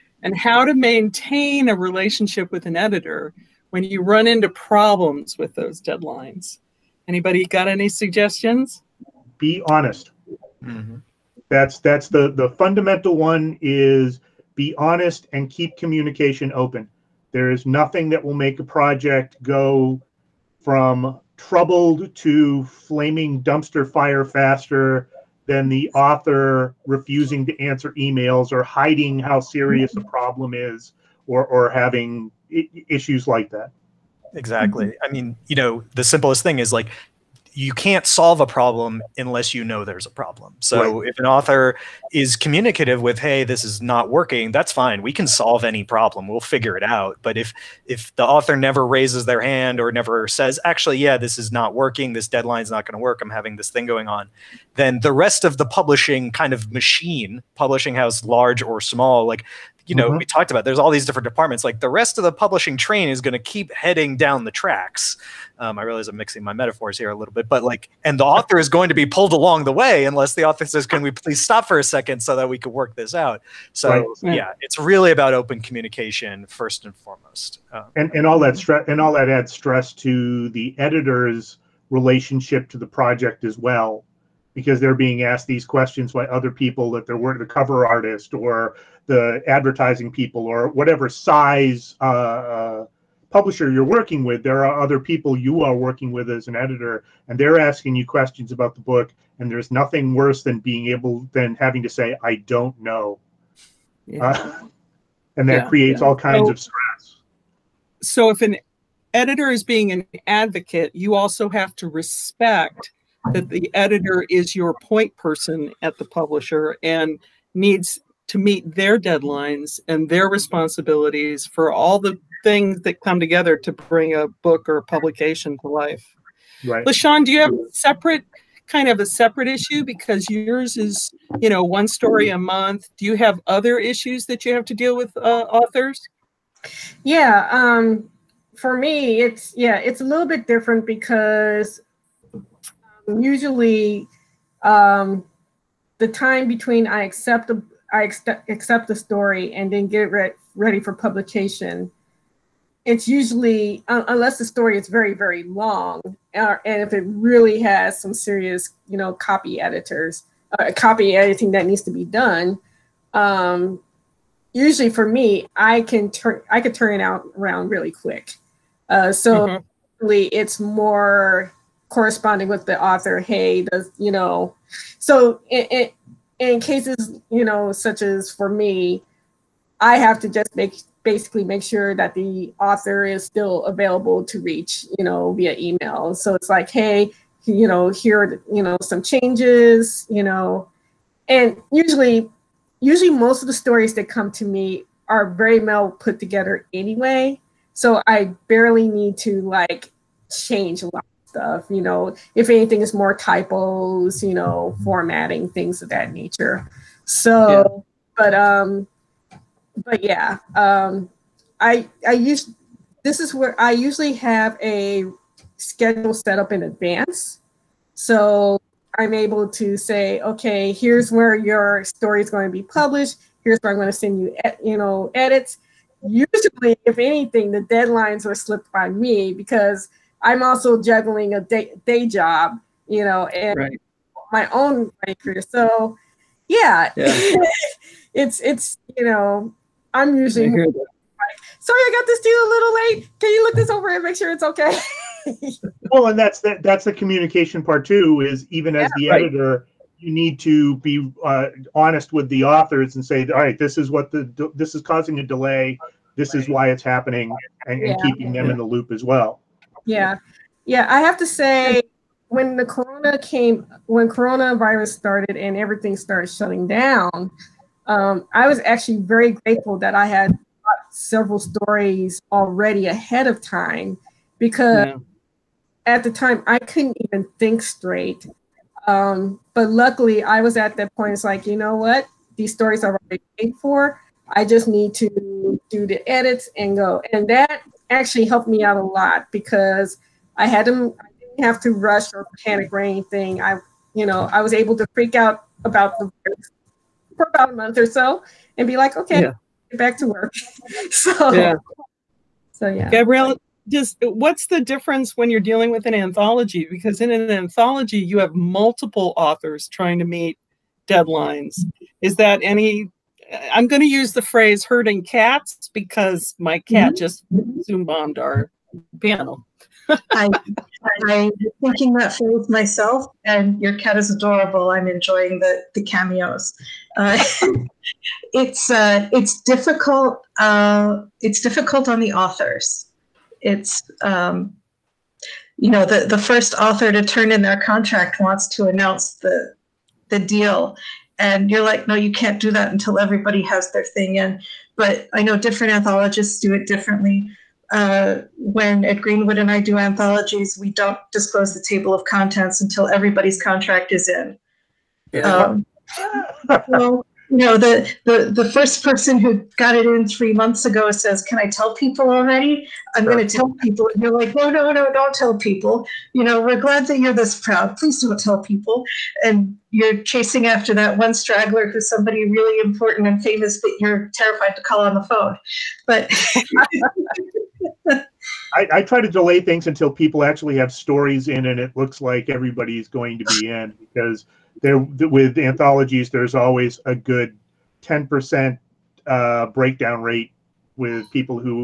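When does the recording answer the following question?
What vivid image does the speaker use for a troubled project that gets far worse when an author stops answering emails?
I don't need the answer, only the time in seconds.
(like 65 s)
22 s.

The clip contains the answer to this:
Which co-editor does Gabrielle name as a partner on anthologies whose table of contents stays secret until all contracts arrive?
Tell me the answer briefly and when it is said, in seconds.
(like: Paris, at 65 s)
Ed Greenwood, at 348 s.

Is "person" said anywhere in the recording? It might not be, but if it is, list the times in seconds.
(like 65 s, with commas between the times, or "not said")
115 s, 358 s.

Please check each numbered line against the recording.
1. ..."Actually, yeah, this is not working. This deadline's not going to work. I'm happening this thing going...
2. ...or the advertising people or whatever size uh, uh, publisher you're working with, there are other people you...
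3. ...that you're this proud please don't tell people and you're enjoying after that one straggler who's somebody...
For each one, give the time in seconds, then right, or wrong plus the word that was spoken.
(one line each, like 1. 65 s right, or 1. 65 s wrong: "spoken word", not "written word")
1. 50 s wrong: "having", not "happening"
2. 88 s right
3. 366 s wrong: "chasing", not "enjoying".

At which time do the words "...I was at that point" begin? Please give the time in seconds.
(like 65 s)
280 s.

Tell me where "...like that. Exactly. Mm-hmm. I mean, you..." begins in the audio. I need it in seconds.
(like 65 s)
33 s.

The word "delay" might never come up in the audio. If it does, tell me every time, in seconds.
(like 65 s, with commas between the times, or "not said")
255 s, 379 s.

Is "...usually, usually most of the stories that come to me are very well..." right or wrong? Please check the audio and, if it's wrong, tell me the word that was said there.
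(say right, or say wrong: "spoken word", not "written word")
right.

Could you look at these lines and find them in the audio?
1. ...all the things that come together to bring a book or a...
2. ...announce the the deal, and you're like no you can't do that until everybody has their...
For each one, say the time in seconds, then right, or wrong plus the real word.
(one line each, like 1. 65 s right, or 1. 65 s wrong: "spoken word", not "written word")
1. 121 s right
2. 338 s right.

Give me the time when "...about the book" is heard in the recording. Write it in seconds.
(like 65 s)
98 s.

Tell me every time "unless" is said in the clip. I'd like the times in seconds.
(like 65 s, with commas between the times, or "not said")
39 s, 70 s, 154 s.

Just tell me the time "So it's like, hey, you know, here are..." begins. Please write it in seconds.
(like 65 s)
186 s.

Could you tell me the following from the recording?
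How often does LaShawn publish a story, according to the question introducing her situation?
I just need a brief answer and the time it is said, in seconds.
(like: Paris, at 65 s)
one story a month, at 131 s.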